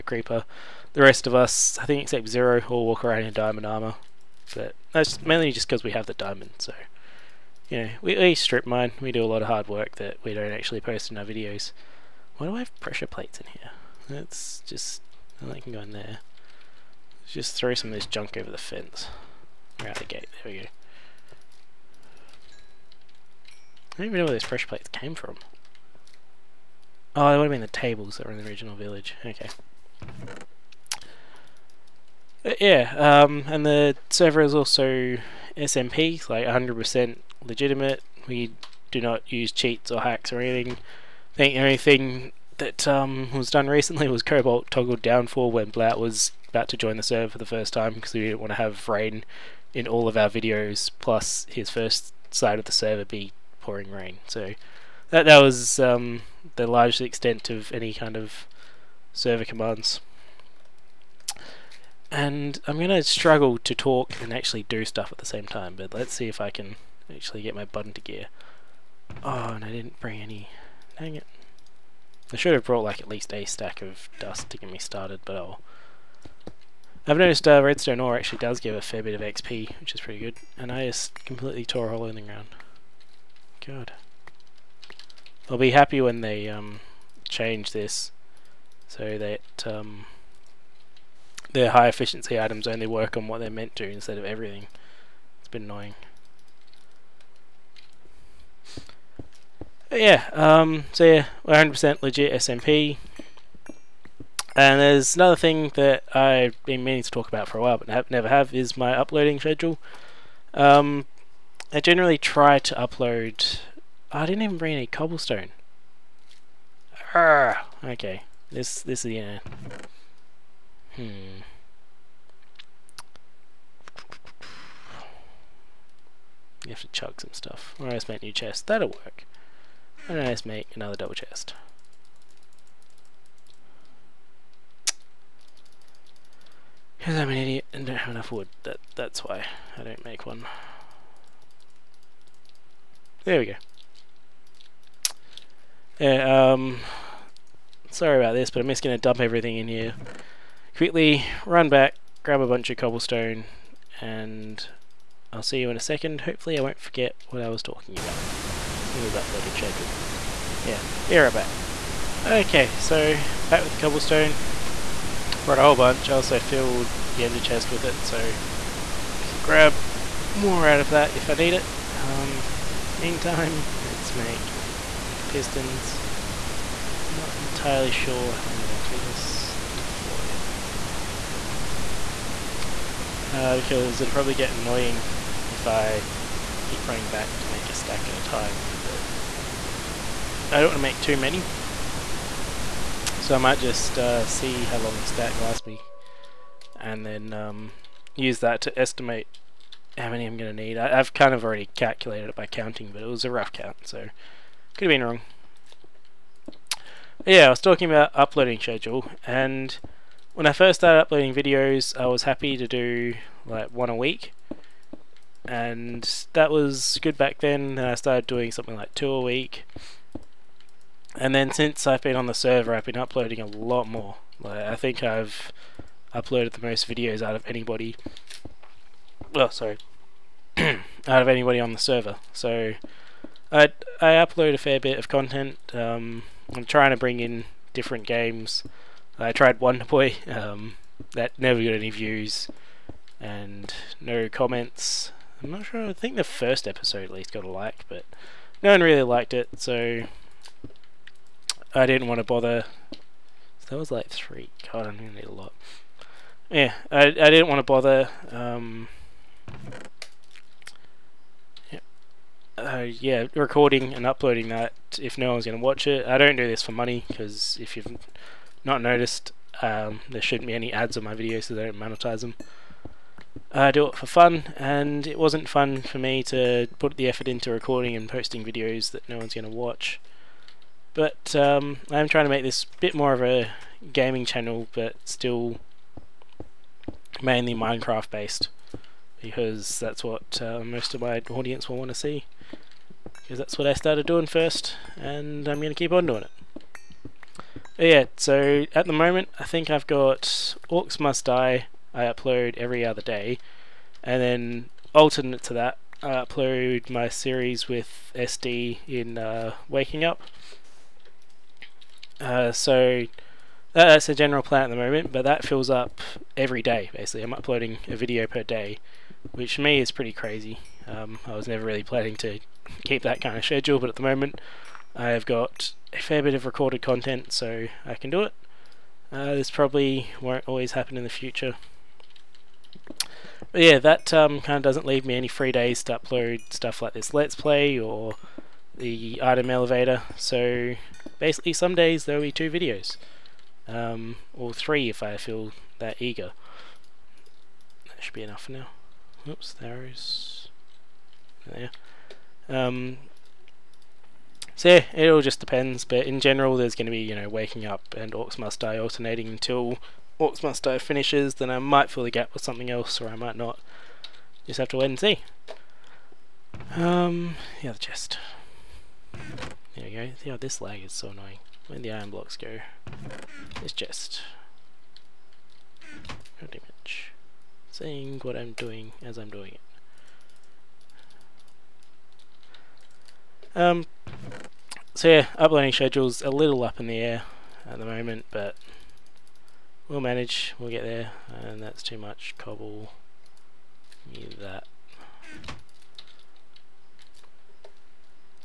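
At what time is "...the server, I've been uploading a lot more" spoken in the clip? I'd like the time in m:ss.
3:42.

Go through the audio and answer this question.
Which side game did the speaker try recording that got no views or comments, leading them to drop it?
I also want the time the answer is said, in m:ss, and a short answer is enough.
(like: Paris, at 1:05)
Wonder Boy, at 3:59.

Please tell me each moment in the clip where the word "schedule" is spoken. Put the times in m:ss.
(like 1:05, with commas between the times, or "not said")
1:49, 2:39, 3:28, 5:23, 6:25.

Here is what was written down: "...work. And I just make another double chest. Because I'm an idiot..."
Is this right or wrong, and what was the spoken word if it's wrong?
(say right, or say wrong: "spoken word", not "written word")
right.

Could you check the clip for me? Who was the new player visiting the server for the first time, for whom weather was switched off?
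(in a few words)
Bluot.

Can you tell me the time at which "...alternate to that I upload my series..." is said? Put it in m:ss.
5:04.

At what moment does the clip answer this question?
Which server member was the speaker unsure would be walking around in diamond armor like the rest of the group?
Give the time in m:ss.
0:02.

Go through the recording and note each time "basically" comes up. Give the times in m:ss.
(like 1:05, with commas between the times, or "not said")
5:16, 5:41.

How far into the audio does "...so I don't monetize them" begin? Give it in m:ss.
4:31.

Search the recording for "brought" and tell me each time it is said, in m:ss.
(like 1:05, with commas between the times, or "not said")
1:12, 2:45.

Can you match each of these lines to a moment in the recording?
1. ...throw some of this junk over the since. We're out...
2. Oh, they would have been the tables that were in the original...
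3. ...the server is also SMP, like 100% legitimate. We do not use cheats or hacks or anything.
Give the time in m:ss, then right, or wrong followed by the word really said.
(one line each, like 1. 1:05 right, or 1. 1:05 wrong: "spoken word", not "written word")
1. 0:17 wrong: "fence", not "since"
2. 0:27 right
3. 0:33 right.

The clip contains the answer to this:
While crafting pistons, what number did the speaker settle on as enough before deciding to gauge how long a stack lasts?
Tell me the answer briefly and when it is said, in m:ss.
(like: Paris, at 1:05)
34, at 2:59.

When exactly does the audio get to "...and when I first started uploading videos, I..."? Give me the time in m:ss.
3:29.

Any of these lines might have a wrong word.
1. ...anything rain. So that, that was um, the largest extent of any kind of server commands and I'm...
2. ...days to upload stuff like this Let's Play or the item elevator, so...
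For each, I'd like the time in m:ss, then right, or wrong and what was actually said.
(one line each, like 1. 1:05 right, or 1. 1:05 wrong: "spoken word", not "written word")
1. 0:53 wrong: "pouring", not "anything"
2. 5:35 right.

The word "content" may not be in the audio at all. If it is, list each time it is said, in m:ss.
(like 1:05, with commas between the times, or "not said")
3:55, 5:26.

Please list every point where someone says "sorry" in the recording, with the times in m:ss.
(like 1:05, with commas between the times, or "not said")
2:27, 3:49.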